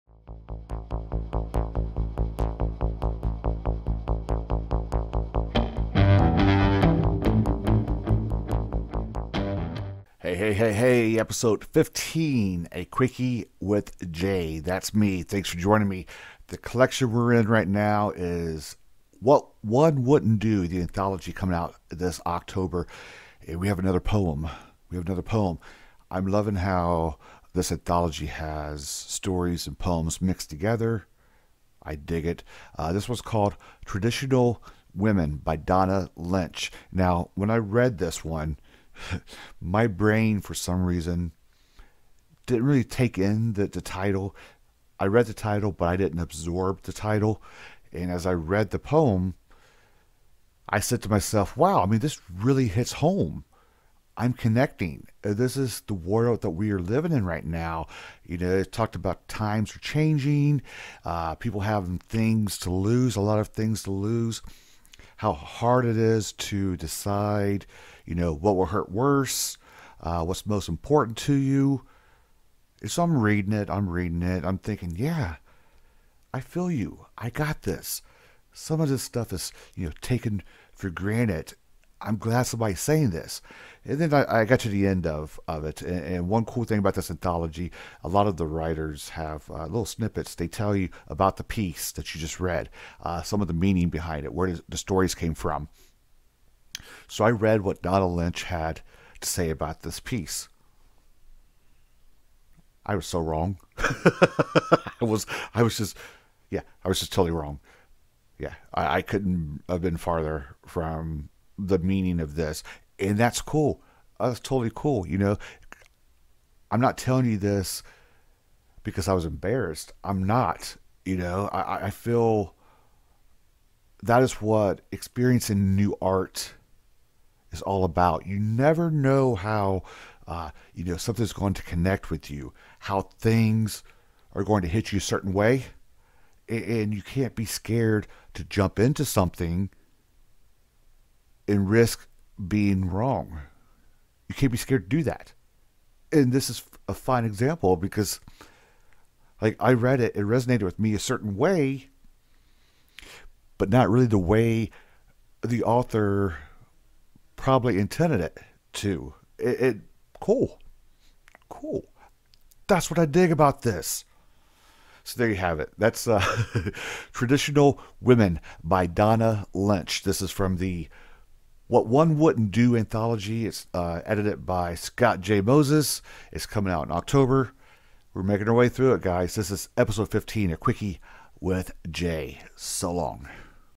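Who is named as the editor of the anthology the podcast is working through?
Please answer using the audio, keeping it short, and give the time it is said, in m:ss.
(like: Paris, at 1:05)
Scott J. Moses, at 2:54.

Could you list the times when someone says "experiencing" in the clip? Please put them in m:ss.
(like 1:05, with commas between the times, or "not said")
2:04.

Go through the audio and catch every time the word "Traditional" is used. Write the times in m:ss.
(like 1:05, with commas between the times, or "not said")
0:33, 2:47.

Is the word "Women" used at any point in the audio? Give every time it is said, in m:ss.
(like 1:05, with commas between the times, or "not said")
0:34, 2:48.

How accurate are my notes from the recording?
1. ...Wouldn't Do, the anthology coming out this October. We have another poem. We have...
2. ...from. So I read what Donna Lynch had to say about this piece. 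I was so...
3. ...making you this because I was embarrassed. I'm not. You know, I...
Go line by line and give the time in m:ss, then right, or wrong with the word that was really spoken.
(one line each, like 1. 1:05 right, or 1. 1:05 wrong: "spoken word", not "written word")
1. 0:20 right
2. 1:35 right
3. 1:56 wrong: "telling", not "making".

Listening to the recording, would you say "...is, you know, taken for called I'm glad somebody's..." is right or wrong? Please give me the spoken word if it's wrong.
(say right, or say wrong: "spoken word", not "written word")
wrong: "granted", not "called".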